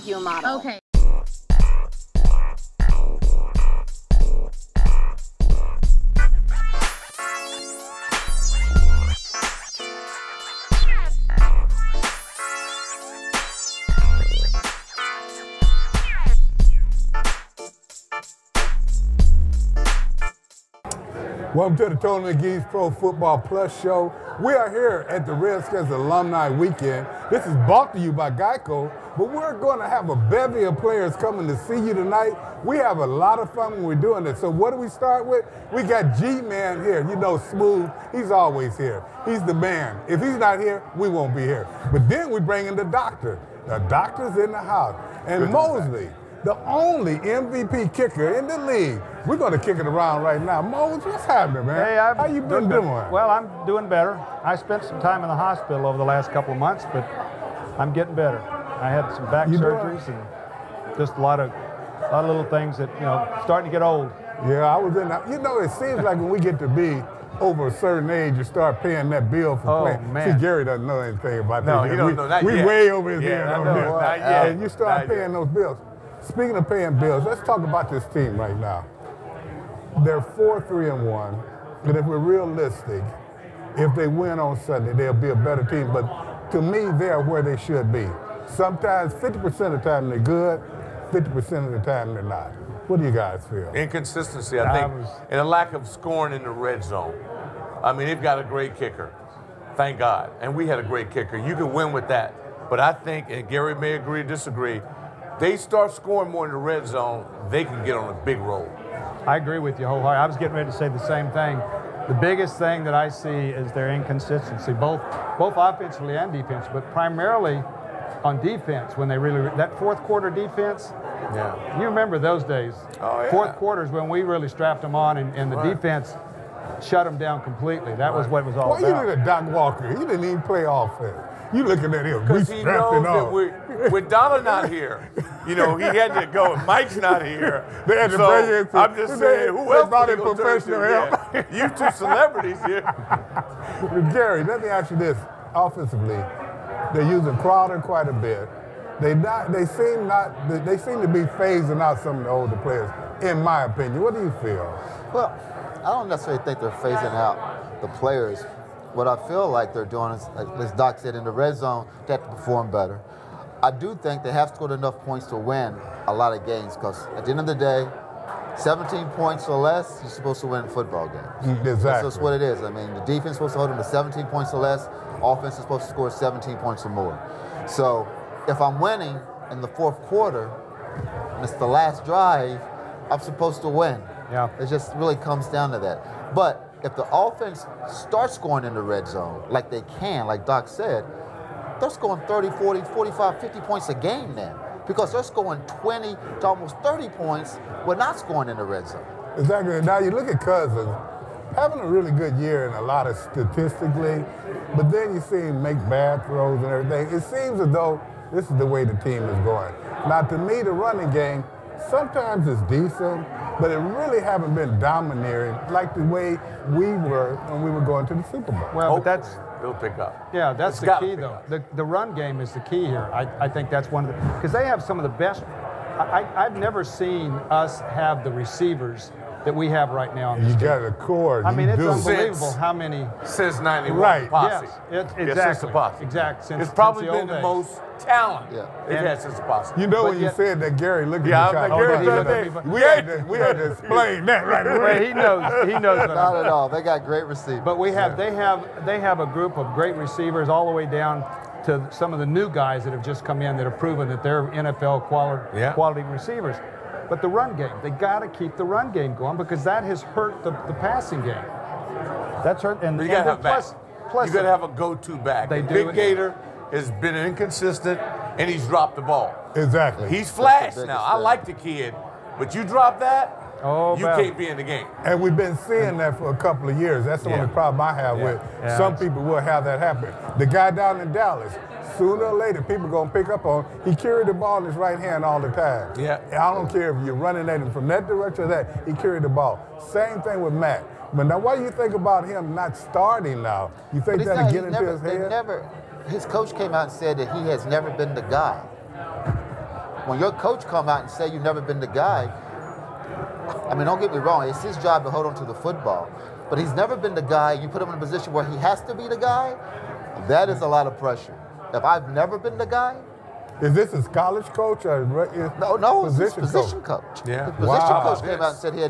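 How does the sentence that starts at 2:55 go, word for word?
Offense is supposed to score 17 points or more.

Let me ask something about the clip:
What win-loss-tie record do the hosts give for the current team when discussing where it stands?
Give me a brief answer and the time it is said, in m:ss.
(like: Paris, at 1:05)
4-3-1, at 1:20.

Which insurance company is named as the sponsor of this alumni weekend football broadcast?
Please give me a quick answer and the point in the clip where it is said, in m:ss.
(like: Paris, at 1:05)
Geico, at 0:28.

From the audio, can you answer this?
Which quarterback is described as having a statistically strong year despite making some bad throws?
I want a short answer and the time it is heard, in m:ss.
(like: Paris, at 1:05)
Cousins, at 3:20.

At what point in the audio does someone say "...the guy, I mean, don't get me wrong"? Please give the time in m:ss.
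5:01.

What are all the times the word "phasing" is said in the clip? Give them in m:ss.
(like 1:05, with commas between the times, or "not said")
2:31, 2:36.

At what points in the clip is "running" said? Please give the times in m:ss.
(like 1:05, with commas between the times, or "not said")
3:30, 4:47.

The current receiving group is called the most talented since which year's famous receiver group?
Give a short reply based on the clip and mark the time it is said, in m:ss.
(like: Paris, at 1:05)
1991, at 3:53.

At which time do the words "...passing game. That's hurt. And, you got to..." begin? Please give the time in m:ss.
4:20.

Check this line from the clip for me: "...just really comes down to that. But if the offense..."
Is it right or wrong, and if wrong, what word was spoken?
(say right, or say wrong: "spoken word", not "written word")
right.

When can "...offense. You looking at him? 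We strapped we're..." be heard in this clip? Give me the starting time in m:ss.
2:10.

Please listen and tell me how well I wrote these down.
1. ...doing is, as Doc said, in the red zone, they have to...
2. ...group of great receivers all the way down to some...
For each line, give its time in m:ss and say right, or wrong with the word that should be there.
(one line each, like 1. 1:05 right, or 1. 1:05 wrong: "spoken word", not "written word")
1. 2:39 right
2. 4:09 right.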